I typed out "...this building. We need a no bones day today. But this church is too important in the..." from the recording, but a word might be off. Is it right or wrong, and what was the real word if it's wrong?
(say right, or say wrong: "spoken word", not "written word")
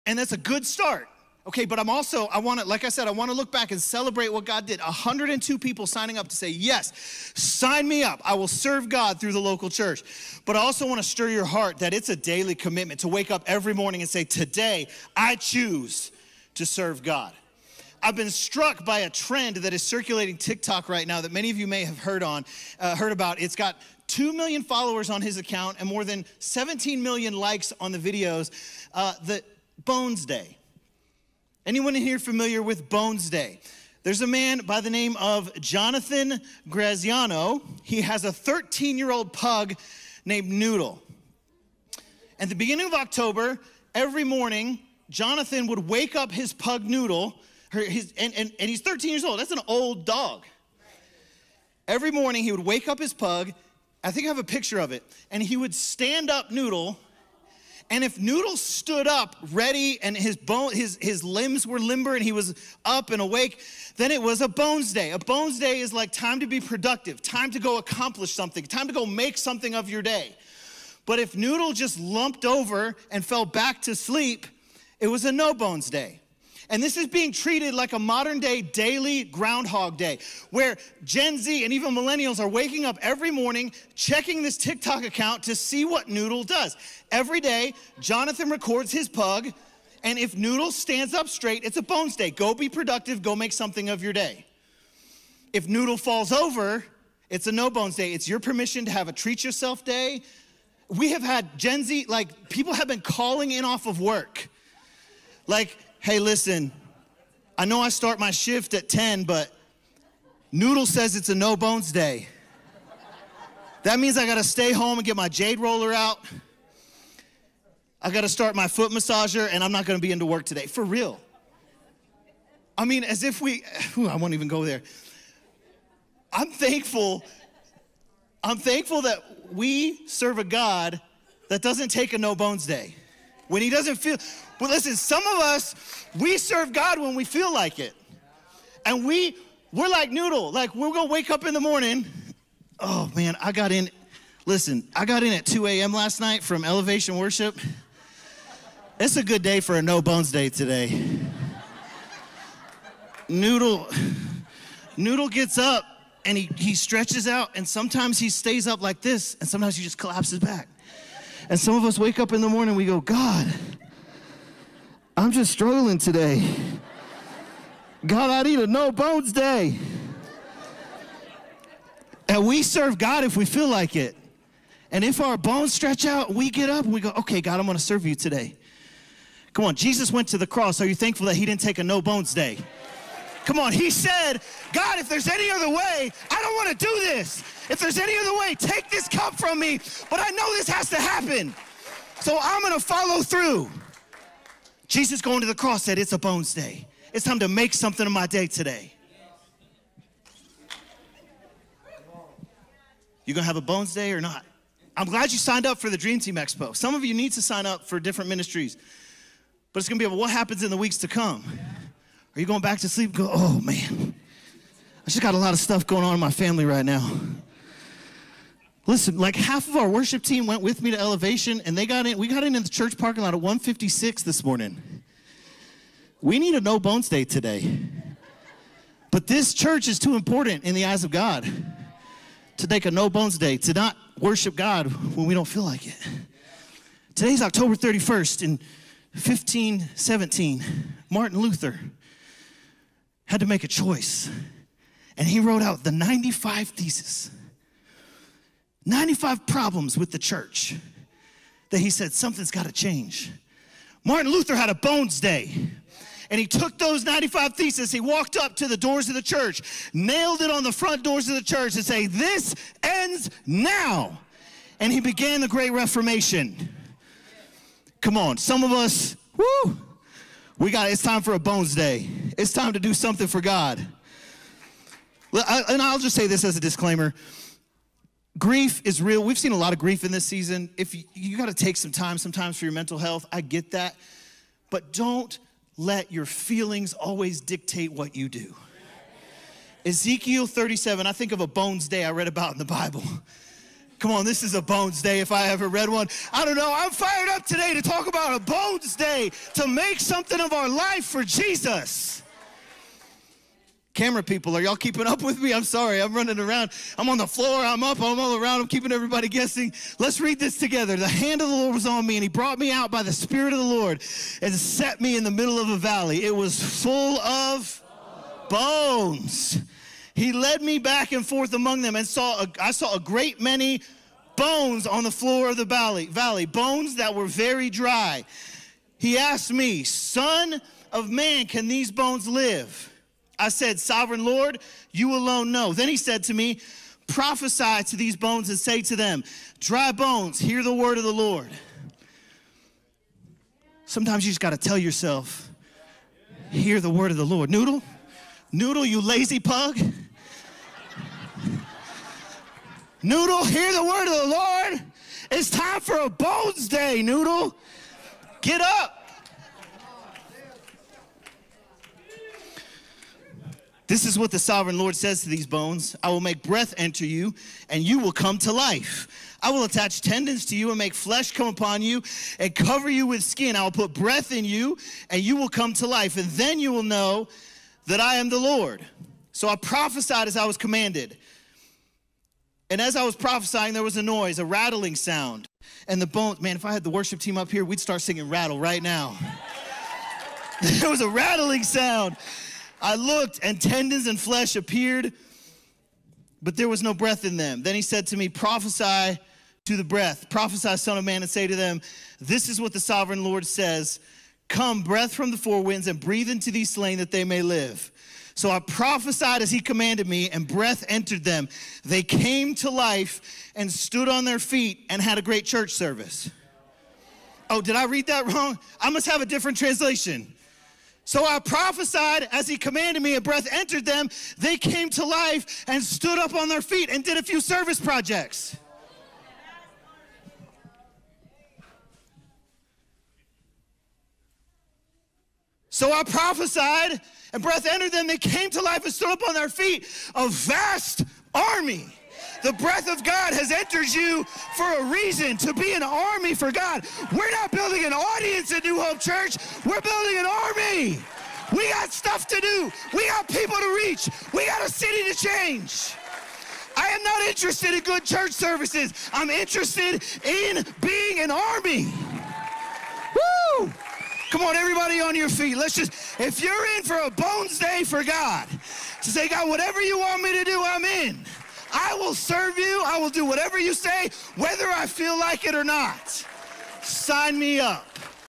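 wrong: "morning", not "building".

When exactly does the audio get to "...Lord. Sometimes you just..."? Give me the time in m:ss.
5:41.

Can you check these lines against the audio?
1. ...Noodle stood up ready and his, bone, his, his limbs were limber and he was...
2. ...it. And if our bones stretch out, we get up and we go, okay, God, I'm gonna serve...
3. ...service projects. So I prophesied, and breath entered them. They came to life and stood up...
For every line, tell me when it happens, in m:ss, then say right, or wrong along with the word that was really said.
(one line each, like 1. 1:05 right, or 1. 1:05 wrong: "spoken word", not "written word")
1. 0:58 right
2. 2:53 right
3. 7:07 right.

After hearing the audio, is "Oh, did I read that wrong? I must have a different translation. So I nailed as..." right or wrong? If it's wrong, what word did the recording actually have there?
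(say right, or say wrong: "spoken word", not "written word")
wrong: "prophesied", not "nailed".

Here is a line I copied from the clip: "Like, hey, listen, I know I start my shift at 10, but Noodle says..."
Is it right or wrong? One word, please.
right.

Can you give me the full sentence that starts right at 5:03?
Camera people, are y'all keeping up with me?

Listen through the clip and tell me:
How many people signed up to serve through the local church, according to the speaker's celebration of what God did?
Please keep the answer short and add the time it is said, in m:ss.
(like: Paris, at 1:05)
102, at 0:04.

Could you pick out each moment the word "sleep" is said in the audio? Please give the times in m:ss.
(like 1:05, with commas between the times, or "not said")
1:13, 3:32.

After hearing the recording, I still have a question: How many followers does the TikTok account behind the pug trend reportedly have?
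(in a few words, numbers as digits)
2 million.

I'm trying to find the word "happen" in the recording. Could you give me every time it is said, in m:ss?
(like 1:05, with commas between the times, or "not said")
3:10, 3:30.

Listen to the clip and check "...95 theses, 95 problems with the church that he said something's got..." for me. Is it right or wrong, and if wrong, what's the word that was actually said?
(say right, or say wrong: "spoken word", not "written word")
right.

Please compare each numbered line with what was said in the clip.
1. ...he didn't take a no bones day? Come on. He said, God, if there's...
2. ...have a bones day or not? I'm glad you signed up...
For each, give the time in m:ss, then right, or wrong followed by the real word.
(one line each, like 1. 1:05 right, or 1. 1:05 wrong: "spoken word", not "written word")
1. 3:01 right
2. 3:23 right.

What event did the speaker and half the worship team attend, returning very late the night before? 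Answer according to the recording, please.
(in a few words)
Elevation Worship.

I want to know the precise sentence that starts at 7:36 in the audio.
I am not interested in good church services, I'm interested in being an army.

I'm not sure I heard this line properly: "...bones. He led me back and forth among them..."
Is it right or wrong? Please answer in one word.
right.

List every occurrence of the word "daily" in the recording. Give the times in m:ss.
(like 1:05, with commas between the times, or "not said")
0:12, 1:18.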